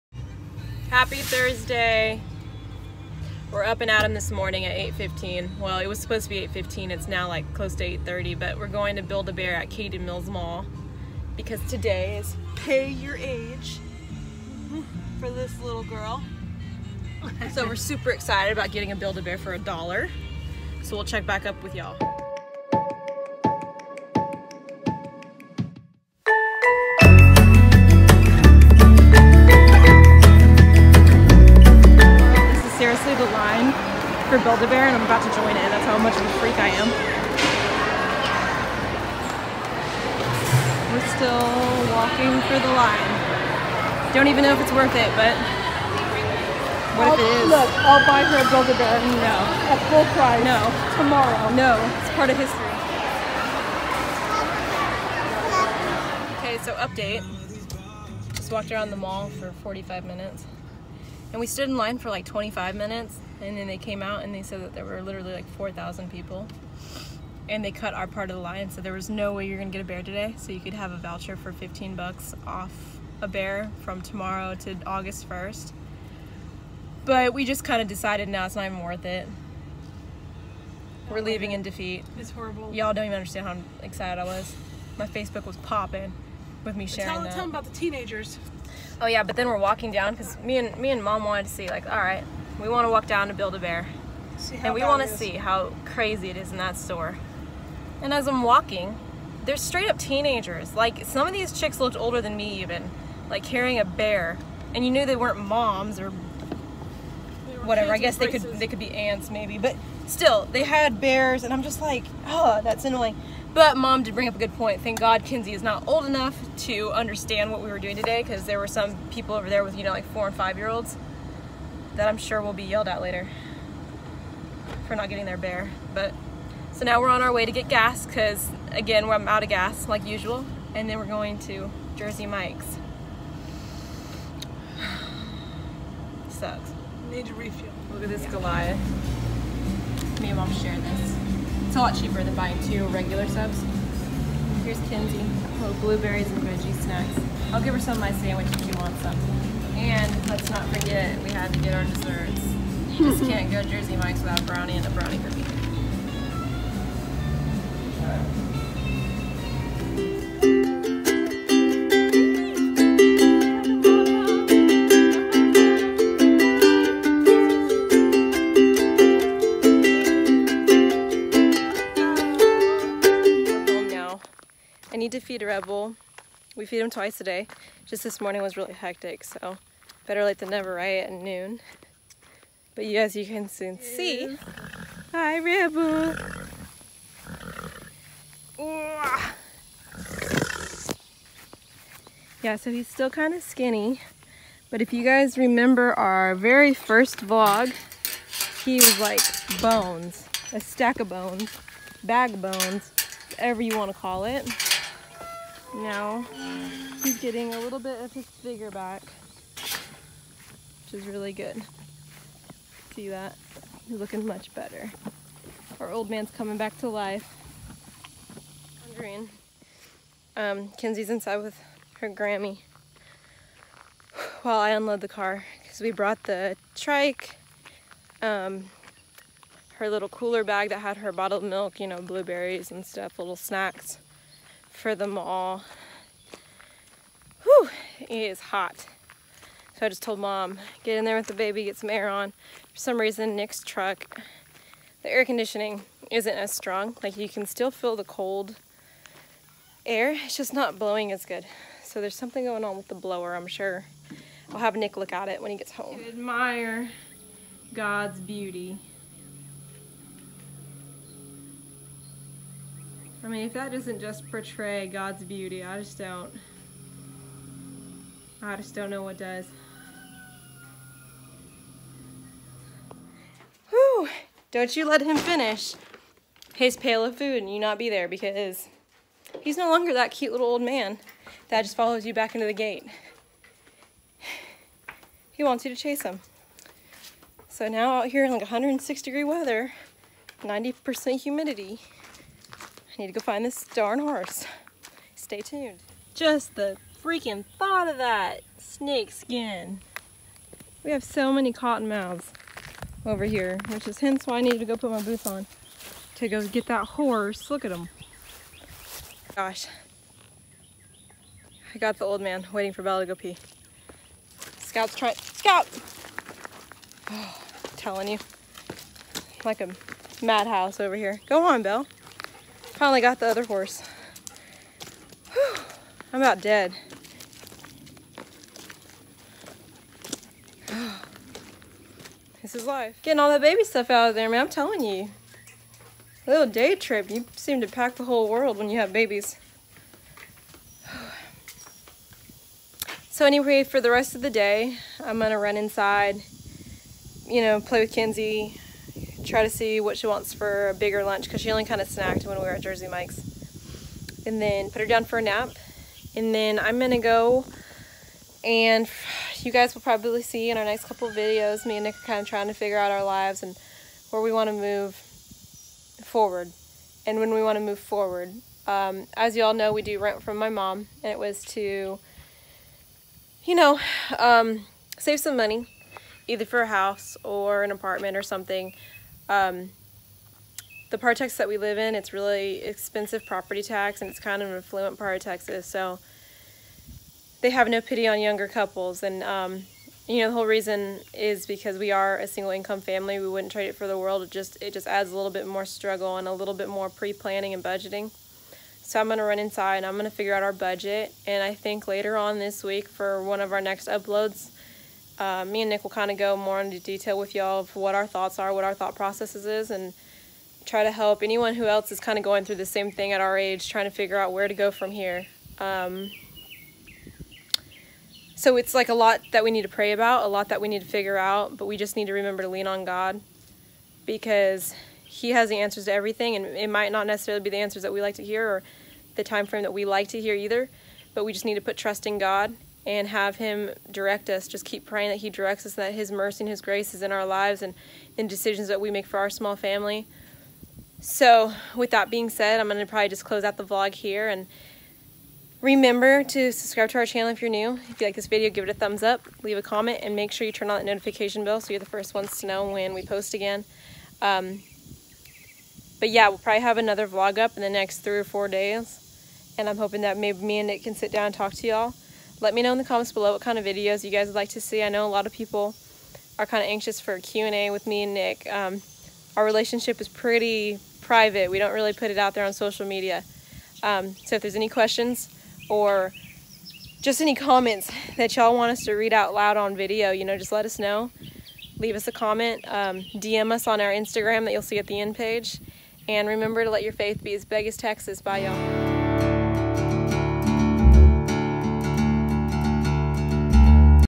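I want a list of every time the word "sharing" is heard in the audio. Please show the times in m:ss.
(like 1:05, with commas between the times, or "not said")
1:26, 2:20.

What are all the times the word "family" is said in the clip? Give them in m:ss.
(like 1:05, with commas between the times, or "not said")
6:32, 7:19.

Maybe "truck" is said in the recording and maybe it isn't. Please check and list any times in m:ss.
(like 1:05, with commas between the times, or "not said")
4:03.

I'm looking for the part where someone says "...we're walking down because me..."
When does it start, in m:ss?
1:29.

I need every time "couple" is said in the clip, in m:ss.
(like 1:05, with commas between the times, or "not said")
6:00, 6:28.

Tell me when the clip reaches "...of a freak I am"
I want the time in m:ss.
0:36.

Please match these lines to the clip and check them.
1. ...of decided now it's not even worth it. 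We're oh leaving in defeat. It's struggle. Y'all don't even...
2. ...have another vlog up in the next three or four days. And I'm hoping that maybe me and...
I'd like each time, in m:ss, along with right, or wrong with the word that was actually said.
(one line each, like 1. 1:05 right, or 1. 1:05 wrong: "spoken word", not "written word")
1. 1:17 wrong: "horrible", not "struggle"
2. 7:36 right.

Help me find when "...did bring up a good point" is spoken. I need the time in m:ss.
1:54.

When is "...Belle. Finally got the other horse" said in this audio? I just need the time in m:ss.
5:21.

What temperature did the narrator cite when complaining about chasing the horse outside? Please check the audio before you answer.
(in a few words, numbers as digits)
106 degrees.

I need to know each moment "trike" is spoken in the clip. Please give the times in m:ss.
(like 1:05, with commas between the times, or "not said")
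3:46.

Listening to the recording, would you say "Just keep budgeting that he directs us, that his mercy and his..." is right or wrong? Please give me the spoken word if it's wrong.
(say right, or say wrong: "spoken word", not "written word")
wrong: "praying", not "budgeting".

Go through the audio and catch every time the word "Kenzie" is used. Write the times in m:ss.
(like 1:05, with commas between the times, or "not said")
3:40, 5:47.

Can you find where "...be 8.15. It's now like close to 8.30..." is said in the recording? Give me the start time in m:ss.
0:06.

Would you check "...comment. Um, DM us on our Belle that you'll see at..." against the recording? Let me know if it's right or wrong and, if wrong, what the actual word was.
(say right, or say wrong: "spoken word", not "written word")
wrong: "Instagram", not "Belle".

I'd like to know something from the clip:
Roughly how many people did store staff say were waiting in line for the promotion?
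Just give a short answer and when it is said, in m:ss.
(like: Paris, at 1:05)
4,000, at 1:05.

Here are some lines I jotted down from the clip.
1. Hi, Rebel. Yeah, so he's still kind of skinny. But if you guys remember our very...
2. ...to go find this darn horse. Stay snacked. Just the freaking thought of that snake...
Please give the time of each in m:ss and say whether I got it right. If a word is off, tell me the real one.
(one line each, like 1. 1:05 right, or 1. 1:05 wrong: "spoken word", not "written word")
1. 3:05 right
2. 4:53 wrong: "tuned", not "snacked".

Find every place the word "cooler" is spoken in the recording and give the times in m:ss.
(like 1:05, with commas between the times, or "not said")
3:50.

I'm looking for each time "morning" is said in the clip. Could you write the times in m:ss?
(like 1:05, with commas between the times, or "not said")
0:04, 2:58.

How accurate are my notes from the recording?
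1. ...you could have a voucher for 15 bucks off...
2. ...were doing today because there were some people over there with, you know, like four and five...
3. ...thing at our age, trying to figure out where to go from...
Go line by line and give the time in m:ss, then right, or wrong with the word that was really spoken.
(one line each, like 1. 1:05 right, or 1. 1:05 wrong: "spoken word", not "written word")
1. 1:10 right
2. 1:57 right
3. 6:52 right.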